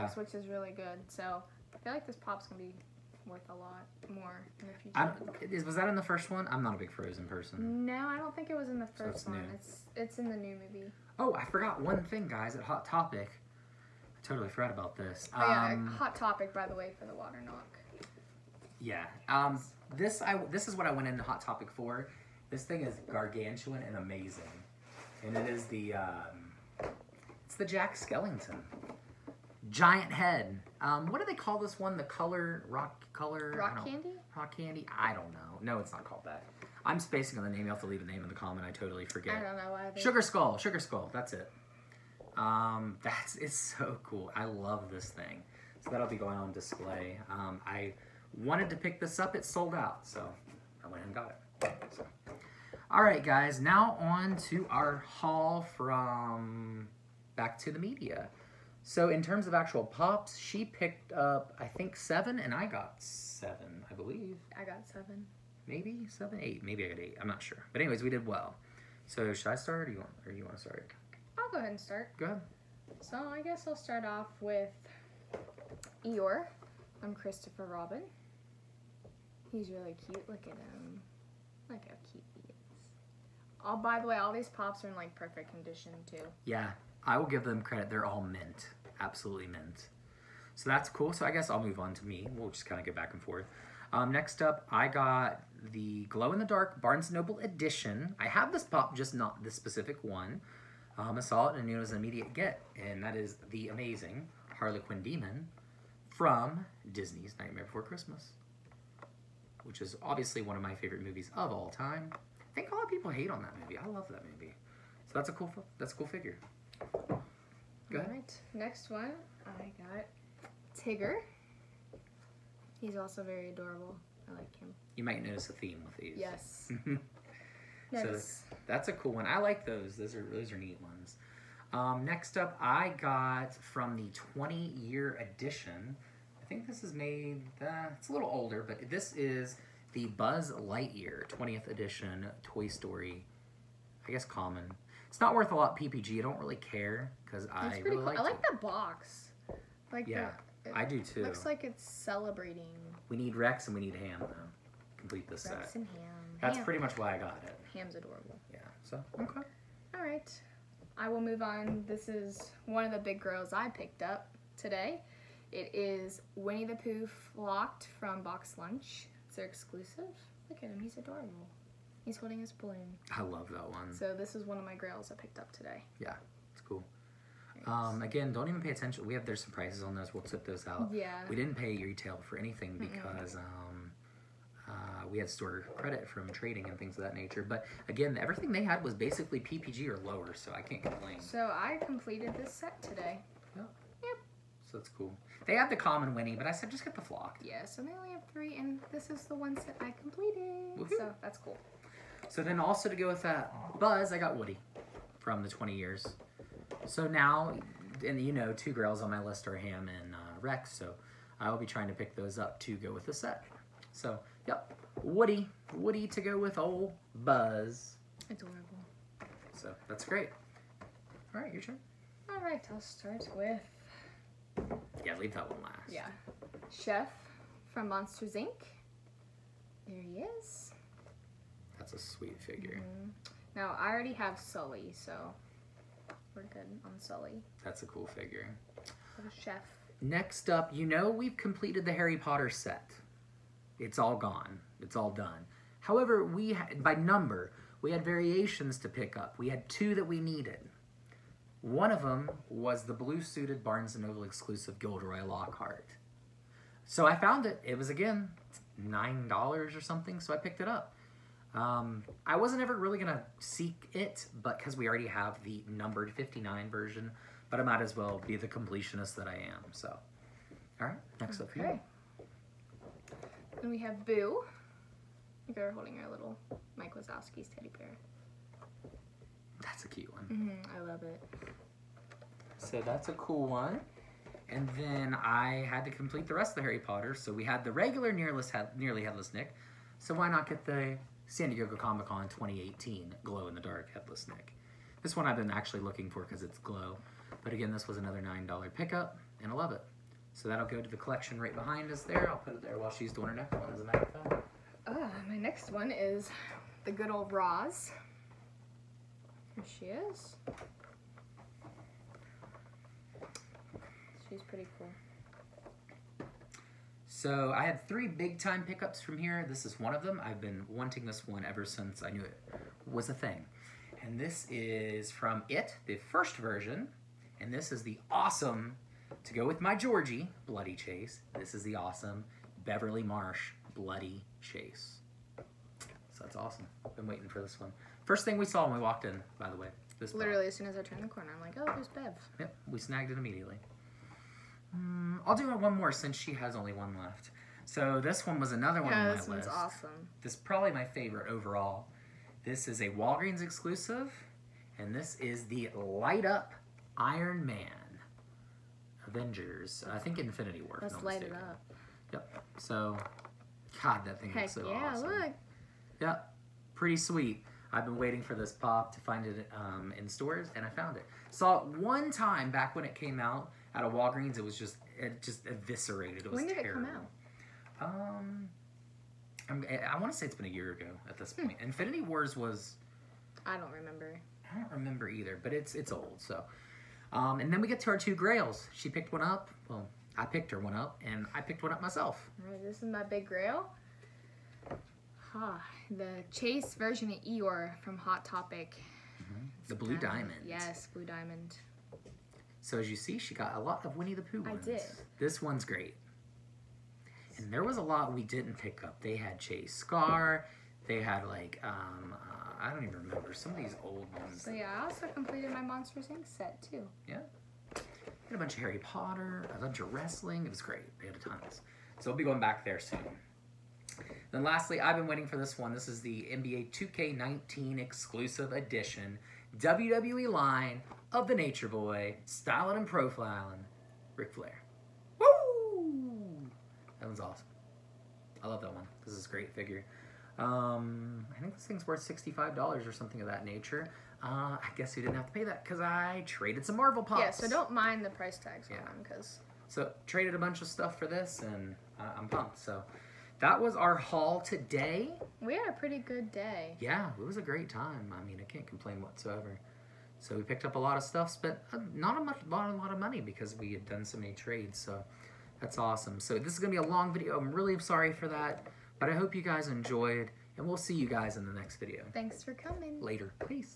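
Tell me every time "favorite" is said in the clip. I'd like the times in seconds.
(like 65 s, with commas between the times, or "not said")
110 s, 350 s.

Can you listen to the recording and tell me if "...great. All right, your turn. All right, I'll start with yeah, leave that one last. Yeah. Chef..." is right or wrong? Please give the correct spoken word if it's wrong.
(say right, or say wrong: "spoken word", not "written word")
right.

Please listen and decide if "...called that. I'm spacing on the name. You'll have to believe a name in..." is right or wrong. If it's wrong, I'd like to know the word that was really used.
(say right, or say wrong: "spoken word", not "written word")
wrong: "leave", not "believe".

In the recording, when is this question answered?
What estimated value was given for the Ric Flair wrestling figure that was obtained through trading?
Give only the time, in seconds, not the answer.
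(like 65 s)
441 s.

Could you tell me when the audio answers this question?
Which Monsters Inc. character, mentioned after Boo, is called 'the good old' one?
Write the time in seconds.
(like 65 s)
307 s.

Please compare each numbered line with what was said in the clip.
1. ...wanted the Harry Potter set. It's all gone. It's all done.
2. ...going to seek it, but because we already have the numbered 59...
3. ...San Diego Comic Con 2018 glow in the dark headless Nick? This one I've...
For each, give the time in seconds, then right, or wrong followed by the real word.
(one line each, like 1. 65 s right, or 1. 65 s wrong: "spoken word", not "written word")
1. 241 s wrong: "completed", not "wanted"
2. 262 s right
3. 291 s right.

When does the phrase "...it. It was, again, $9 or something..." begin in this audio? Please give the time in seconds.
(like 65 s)
257 s.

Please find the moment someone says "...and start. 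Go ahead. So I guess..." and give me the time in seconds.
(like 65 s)
71 s.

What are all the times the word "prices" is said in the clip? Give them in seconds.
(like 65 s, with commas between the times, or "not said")
179 s, 448 s.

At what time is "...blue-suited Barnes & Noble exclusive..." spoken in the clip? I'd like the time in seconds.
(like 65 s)
252 s.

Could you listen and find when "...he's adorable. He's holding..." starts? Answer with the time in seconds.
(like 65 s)
170 s.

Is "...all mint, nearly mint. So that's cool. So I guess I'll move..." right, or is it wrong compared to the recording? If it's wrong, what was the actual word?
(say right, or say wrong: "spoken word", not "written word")
wrong: "absolutely", not "nearly".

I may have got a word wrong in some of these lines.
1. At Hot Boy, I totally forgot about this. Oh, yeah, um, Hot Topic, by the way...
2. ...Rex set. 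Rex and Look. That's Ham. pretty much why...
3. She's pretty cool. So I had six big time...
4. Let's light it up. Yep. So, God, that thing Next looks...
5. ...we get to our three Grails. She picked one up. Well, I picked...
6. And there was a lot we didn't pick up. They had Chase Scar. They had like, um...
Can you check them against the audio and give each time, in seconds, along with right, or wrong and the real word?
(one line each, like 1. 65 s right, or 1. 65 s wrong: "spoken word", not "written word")
1. 12 s wrong: "Topic", not "Boy"
2. 155 s wrong: "Ham", not "Look"
3. 314 s wrong: "three", not "six"
4. 360 s wrong: "Heck", not "Next"
5. 387 s wrong: "two", not "three"
6. 407 s right.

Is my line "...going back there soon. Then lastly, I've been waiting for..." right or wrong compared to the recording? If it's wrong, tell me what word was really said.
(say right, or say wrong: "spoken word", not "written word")
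right.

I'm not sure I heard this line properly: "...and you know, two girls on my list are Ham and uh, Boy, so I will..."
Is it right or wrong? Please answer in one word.
wrong.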